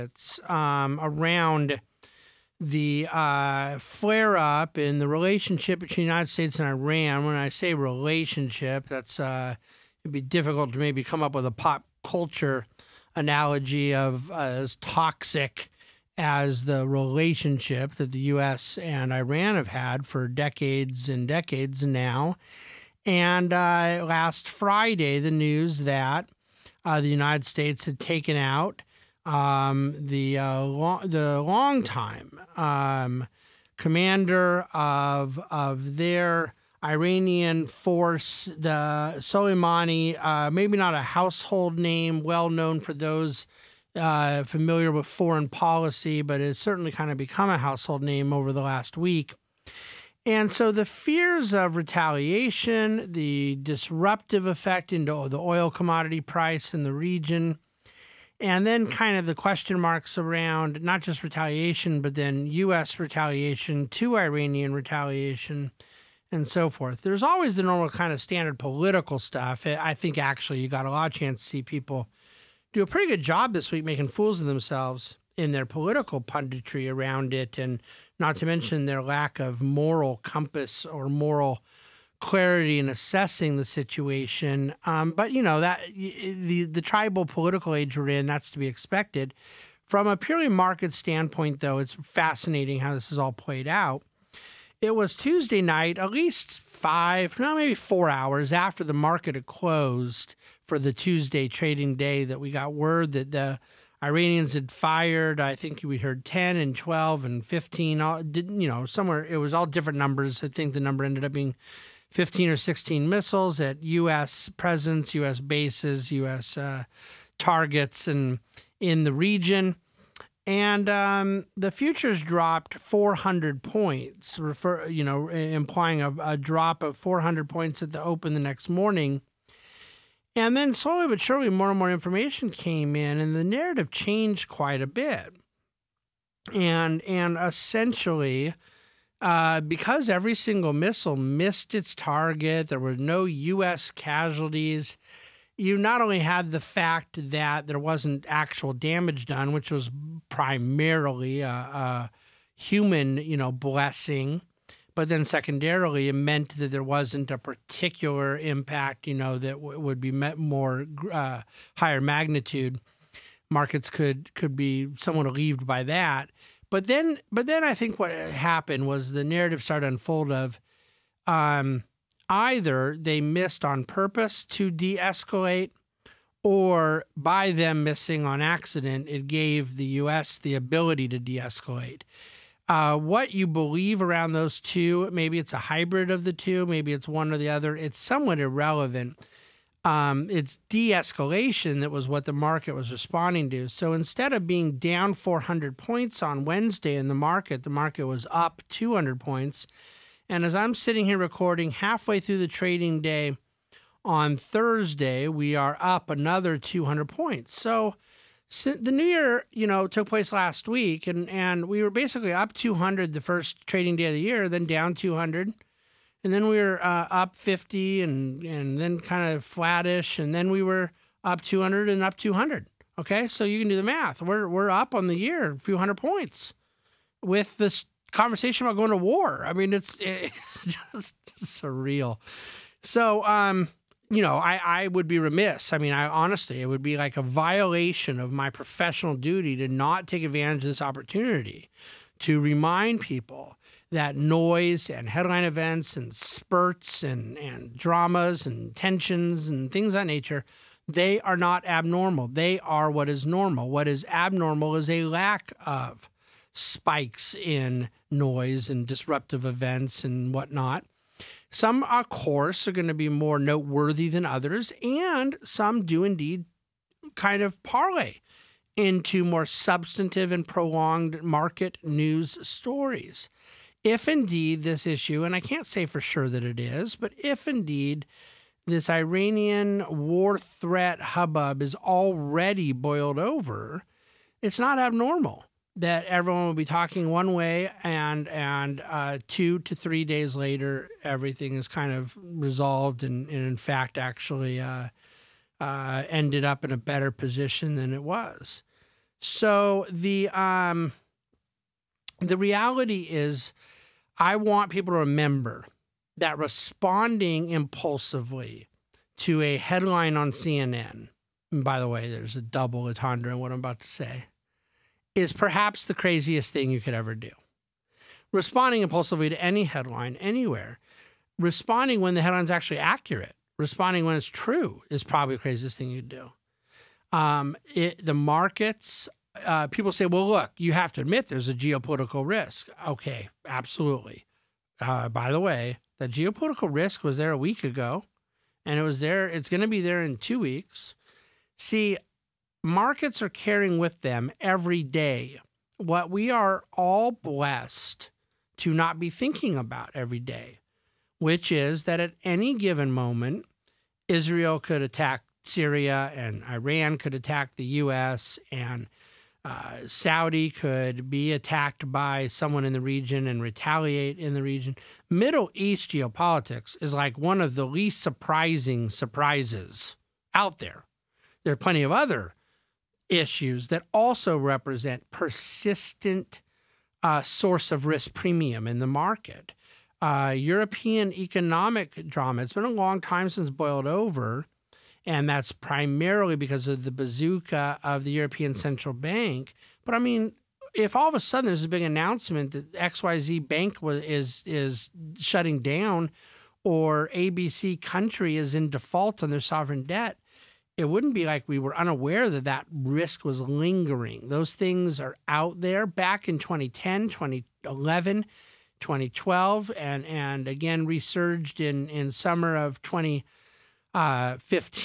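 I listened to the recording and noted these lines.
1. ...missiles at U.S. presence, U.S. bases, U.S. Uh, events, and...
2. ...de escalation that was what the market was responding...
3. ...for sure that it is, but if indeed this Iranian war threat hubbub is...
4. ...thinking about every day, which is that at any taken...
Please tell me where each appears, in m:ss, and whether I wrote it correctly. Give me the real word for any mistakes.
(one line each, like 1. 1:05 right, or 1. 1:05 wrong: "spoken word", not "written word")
1. 1:53 wrong: "targets", not "events"
2. 3:10 right
3. 4:35 right
4. 5:49 wrong: "given", not "taken".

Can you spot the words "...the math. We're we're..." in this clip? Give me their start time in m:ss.
3:43.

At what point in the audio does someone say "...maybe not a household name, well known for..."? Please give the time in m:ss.
0:40.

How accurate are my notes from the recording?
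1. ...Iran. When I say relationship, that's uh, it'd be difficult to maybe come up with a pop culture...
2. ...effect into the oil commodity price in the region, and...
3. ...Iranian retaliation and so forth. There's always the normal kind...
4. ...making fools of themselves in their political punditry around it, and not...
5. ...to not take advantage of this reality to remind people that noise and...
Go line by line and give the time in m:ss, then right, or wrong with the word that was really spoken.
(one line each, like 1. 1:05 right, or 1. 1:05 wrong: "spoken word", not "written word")
1. 0:06 right
2. 0:54 right
3. 1:04 right
4. 1:13 right
5. 3:59 wrong: "opportunity", not "reality".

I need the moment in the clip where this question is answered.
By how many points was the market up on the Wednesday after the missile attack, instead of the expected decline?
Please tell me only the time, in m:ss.
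3:17.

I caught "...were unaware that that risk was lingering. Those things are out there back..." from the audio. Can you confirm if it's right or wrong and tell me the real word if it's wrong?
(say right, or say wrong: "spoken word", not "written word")
right.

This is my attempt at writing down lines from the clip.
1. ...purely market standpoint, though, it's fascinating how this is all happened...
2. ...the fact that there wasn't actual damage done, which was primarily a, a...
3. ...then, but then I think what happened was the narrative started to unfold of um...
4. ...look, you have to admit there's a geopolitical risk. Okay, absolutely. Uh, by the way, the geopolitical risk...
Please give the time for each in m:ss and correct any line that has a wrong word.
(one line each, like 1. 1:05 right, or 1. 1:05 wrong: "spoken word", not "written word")
1. 1:30 wrong: "played", not "happened"
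2. 2:26 right
3. 2:46 right
4. 5:30 right.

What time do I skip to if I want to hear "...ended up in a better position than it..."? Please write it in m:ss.
4:56.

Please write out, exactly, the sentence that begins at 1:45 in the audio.
I think we heard 10 and 12 and 15.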